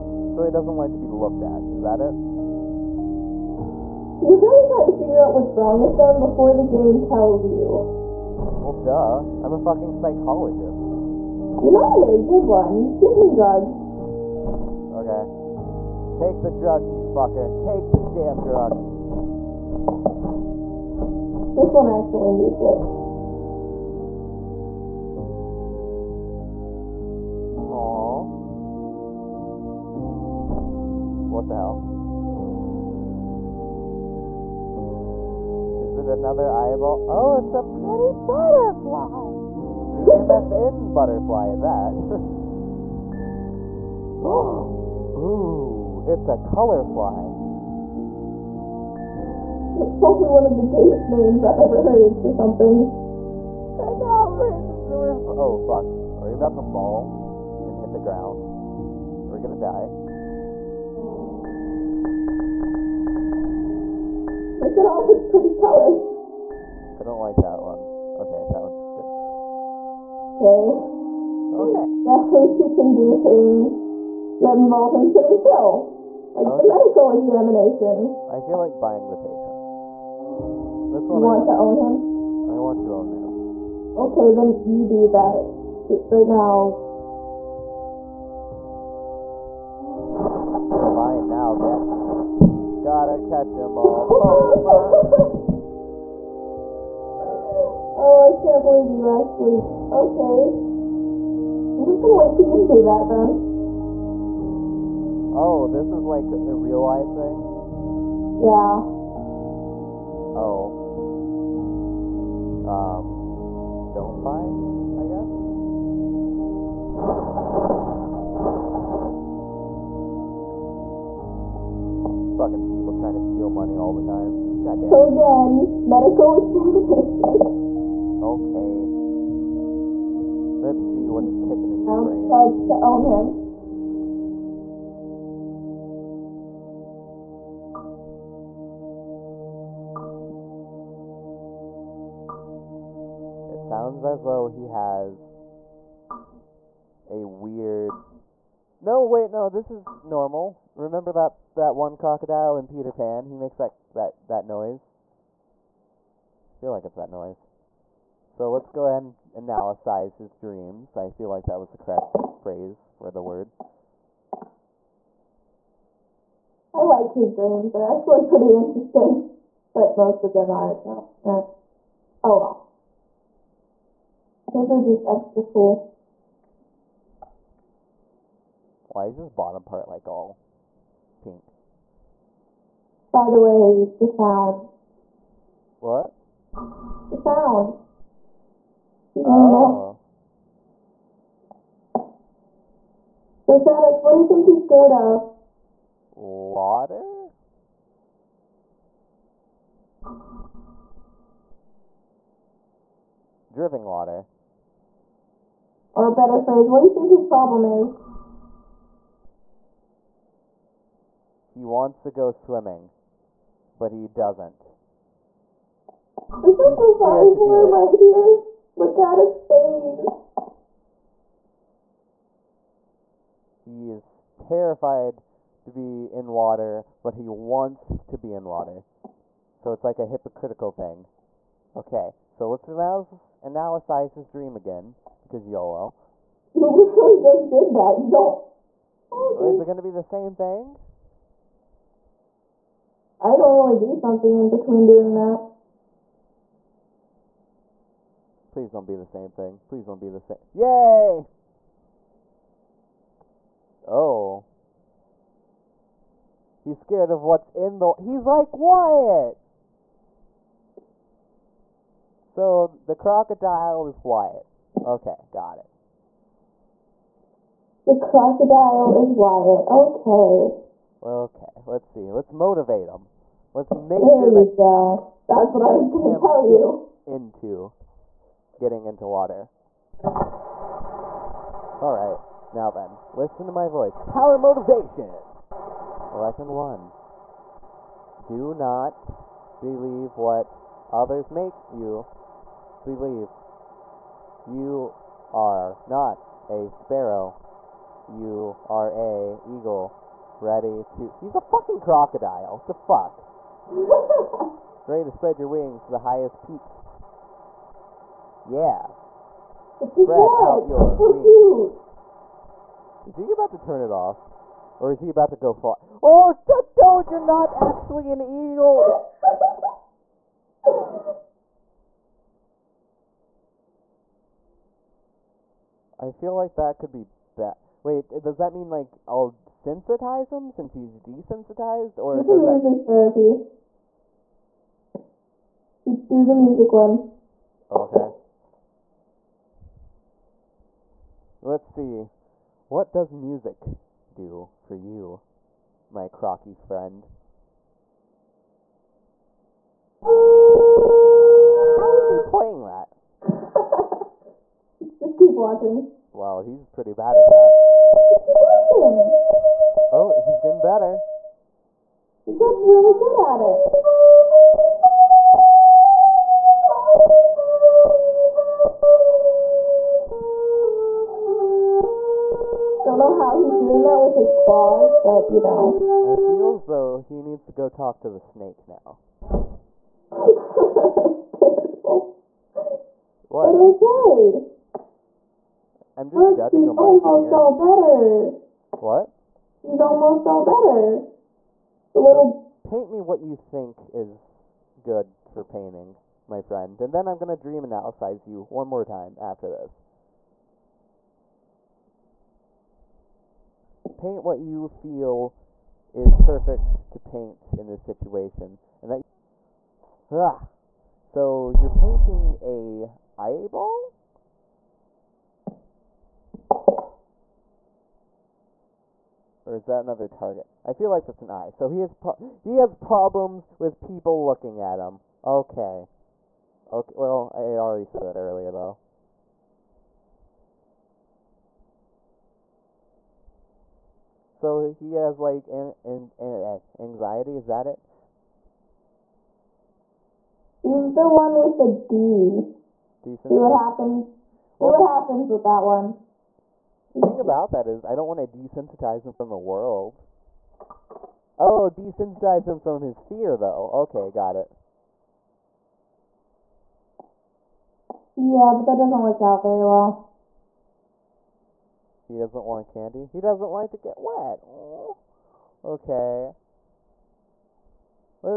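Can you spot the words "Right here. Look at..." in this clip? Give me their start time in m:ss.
3:37.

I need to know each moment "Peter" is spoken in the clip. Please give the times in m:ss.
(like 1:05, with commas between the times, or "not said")
2:32.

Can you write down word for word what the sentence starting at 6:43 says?
paint what you feel is perfect to paint in this situation.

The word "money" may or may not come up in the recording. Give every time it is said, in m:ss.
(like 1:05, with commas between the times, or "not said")
2:03.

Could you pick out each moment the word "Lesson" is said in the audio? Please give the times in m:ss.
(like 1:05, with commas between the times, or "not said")
4:46.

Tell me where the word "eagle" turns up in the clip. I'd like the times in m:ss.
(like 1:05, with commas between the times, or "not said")
4:59, 5:18.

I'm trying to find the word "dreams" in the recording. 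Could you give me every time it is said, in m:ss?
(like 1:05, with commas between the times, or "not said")
2:40, 2:47, 3:54, 6:37.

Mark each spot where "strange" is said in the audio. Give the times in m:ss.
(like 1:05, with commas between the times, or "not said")
not said.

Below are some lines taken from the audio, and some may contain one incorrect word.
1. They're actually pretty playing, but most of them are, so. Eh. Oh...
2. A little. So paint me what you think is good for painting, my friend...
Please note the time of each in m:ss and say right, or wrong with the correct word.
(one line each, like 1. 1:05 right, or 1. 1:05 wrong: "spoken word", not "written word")
1. 2:47 wrong: "interesting", not "playing"
2. 6:31 right.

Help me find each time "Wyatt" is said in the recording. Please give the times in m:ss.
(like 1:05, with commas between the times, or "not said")
4:18, 4:24, 4:29.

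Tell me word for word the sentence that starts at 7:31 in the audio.
Oh, desensitize him from his fear, though.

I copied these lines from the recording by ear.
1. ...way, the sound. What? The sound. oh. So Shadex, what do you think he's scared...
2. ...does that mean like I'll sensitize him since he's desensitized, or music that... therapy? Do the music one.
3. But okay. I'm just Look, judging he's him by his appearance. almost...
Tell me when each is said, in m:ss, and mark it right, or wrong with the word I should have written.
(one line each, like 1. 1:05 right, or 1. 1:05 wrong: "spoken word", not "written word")
1. 3:03 right
2. 5:28 right
3. 6:23 right.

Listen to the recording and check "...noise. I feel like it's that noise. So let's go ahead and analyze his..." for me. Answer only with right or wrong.
right.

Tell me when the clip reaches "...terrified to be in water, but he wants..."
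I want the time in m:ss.
3:44.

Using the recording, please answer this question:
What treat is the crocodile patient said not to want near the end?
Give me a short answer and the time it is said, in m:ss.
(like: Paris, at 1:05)
candy, at 7:42.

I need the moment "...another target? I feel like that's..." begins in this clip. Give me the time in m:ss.
6:59.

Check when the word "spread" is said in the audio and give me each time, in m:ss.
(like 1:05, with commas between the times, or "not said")
5:05, 5:09.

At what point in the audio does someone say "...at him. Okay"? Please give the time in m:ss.
7:04.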